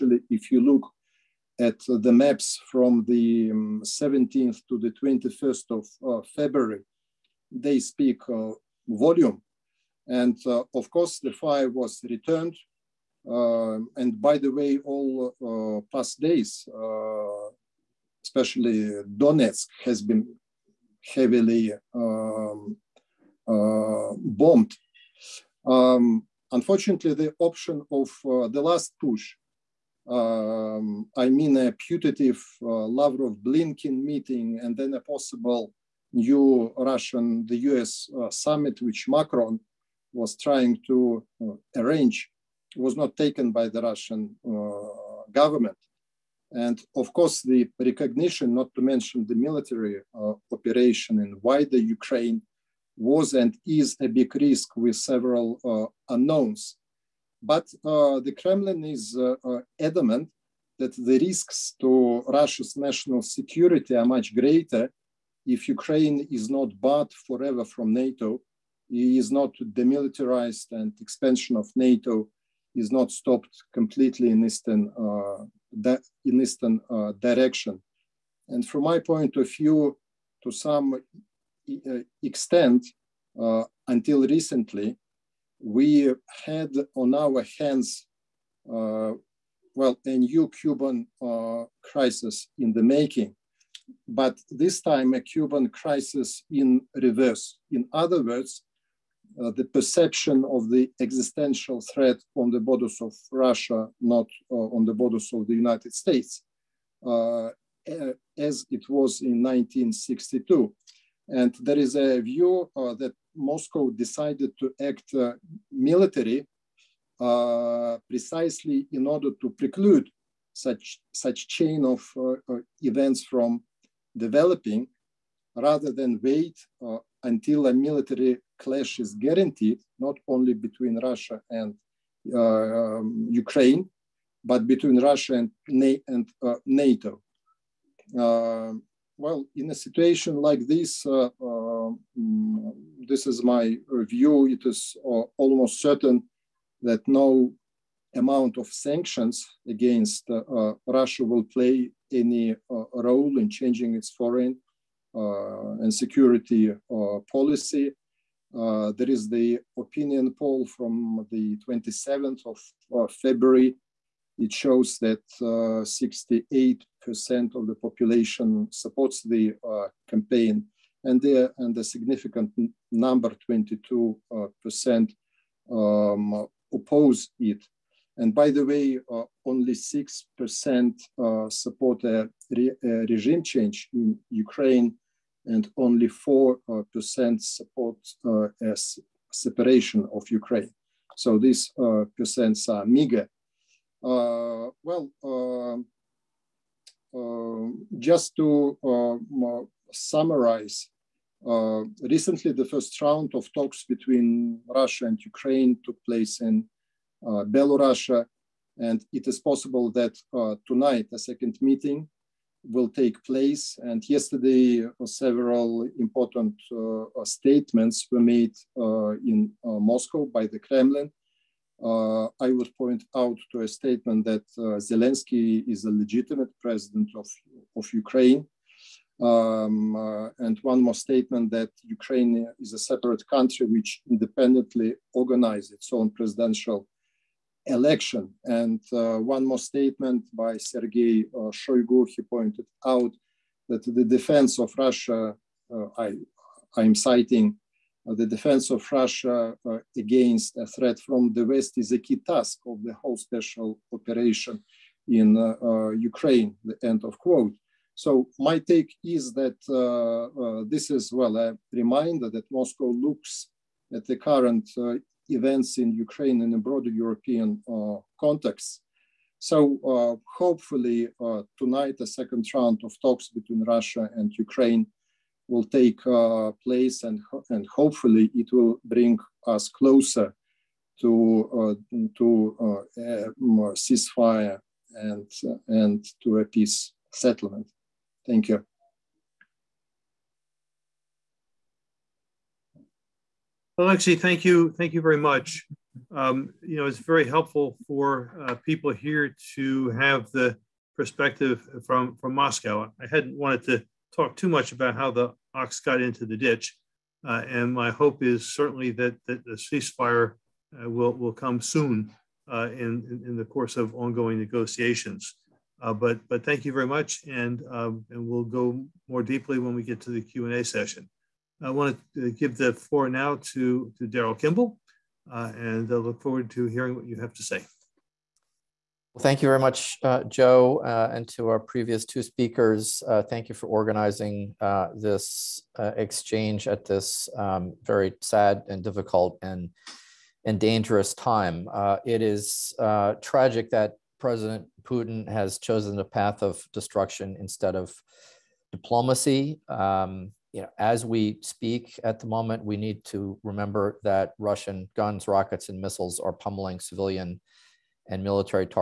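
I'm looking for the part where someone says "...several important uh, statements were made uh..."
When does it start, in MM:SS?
03:35.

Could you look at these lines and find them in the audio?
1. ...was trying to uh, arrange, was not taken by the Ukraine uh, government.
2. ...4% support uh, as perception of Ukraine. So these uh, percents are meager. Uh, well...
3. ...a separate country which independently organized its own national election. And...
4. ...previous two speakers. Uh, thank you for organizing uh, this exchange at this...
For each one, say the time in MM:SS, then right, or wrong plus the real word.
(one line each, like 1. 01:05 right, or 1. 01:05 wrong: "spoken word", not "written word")
1. 00:40 wrong: "Russian", not "Ukraine"
2. 03:06 wrong: "separation", not "perception"
3. 03:52 wrong: "presidential", not "national"
4. 05:31 right.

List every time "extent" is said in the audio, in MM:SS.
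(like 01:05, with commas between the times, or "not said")
01:22.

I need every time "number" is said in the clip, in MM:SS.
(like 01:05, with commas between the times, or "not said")
02:52.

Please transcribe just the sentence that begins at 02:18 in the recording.
Uh, well, in a situation like this, uh, um, this is my view.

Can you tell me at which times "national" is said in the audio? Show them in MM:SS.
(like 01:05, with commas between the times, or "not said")
01:02.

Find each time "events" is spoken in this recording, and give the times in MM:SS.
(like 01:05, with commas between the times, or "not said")
02:02, 04:25.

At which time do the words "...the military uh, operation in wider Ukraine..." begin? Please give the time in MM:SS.
00:49.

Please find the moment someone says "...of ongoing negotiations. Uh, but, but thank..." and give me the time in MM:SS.
05:13.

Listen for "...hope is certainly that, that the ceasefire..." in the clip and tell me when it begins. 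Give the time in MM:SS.
05:07.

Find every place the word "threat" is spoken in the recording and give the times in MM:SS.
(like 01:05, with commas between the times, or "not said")
01:41, 04:10.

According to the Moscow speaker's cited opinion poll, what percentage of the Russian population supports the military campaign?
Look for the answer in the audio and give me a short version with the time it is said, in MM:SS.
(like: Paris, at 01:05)
68%, at 02:45.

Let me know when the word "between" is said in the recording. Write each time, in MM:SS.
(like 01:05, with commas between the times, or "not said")
02:10, 02:14, 03:23, 04:33.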